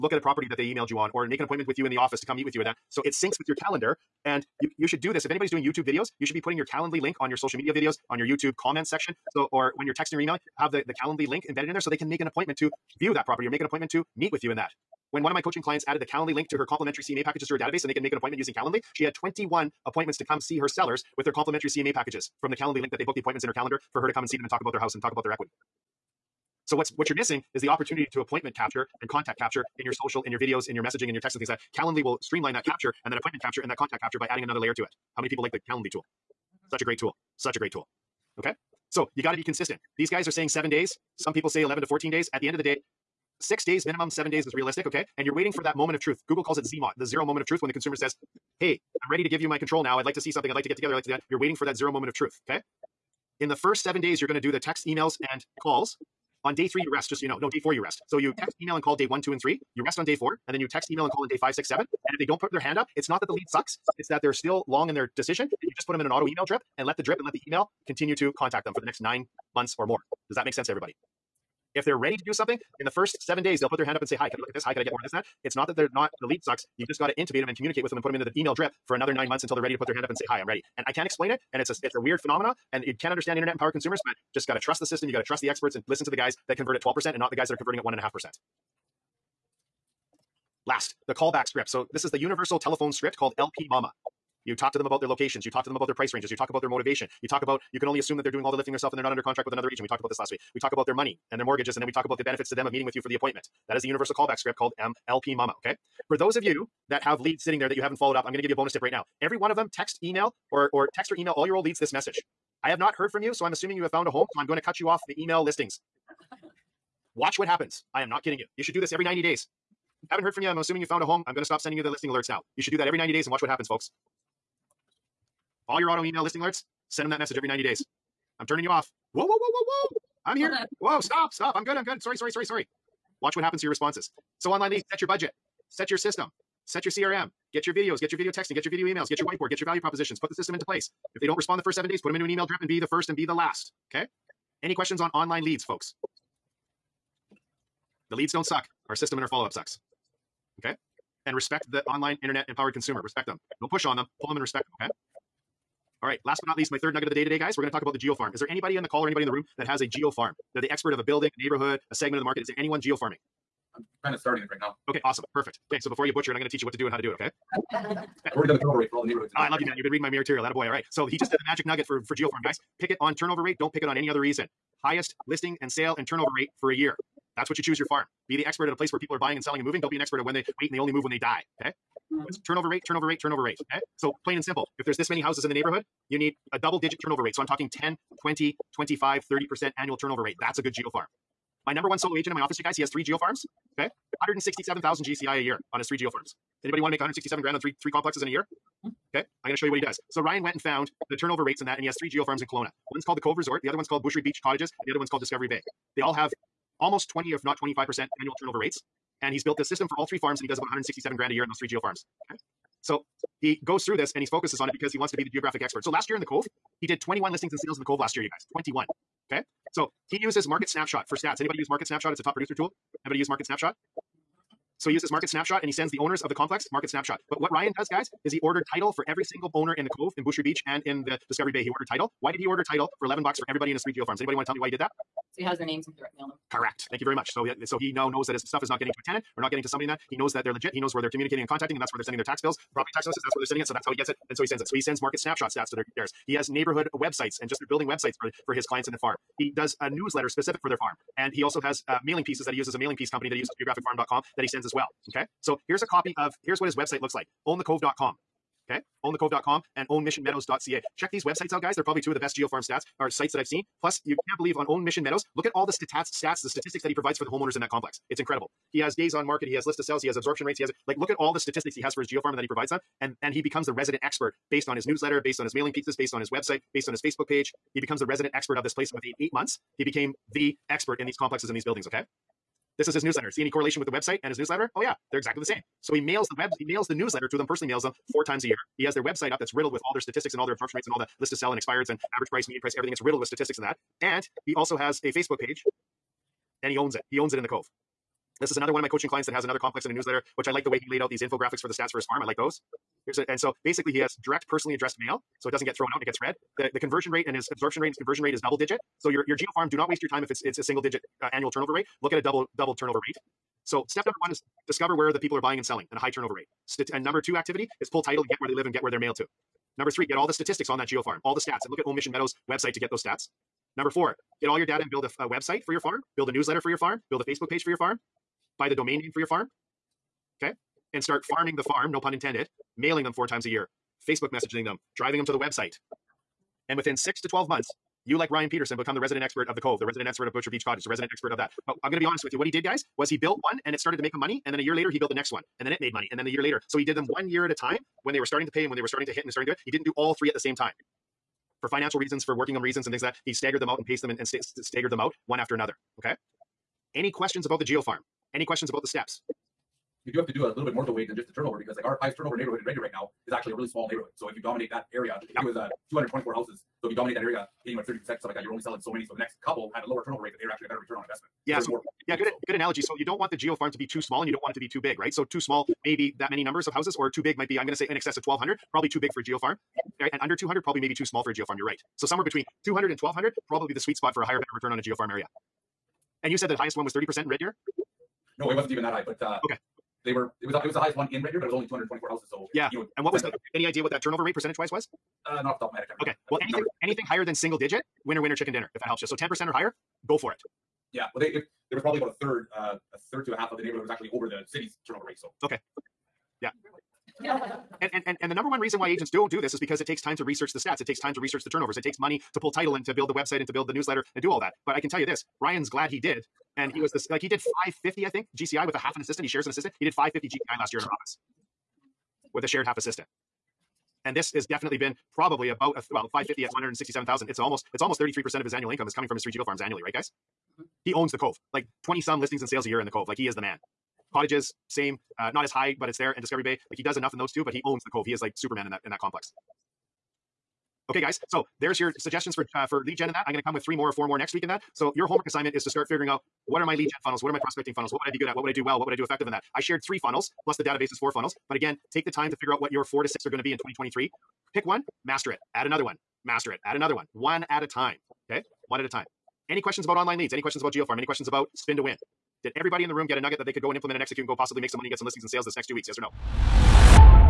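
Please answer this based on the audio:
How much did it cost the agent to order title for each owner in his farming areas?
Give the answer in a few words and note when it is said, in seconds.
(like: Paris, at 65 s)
11 bucks, at 233 s.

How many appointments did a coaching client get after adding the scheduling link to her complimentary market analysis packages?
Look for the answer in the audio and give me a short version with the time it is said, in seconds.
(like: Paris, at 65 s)
21, at 18 s.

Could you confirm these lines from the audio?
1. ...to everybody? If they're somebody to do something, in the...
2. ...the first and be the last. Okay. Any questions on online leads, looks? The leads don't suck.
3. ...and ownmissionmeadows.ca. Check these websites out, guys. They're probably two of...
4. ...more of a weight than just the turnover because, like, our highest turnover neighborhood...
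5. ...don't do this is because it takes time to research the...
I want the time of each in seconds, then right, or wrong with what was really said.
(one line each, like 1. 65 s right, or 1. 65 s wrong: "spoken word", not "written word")
1. 70 s wrong: "ready", not "somebody"
2. 142 s wrong: "folks", not "looks"
3. 259 s right
4. 360 s right
5. 409 s right.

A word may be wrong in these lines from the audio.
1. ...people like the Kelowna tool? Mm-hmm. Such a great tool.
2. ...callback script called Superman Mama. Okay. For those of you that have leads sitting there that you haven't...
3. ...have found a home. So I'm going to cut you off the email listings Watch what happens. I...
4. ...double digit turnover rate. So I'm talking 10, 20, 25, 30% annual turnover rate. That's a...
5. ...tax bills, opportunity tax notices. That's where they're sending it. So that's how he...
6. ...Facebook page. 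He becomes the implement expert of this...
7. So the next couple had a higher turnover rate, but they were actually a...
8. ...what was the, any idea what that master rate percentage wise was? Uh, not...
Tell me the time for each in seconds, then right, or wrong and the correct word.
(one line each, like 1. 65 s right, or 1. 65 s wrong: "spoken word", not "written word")
1. 35 s wrong: "Calendly", not "Kelowna"
2. 104 s wrong: "MLP", not "Superman"
3. 113 s right
4. 186 s right
5. 242 s wrong: "property", not "opportunity"
6. 277 s wrong: "resident", not "implement"
7. 369 s wrong: "lower", not "higher"
8. 393 s wrong: "turnover", not "master".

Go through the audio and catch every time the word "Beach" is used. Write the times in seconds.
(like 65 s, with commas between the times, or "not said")
204 s, 230 s, 340 s.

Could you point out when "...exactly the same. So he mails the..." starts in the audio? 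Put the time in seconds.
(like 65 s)
285 s.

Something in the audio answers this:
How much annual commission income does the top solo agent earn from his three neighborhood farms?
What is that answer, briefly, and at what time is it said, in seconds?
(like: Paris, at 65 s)
167,000, at 194 s.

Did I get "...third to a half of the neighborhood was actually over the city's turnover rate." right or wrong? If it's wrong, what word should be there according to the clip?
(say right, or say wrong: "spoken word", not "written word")
right.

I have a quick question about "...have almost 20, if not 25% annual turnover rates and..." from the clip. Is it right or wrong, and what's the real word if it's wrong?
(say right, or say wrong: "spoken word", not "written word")
right.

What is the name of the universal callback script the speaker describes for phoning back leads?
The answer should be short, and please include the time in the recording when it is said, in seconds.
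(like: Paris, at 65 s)
LP Mama, at 93 s.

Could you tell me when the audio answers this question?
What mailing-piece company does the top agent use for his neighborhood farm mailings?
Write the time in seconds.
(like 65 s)
253 s.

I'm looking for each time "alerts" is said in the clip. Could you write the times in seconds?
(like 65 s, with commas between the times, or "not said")
122 s, 126 s.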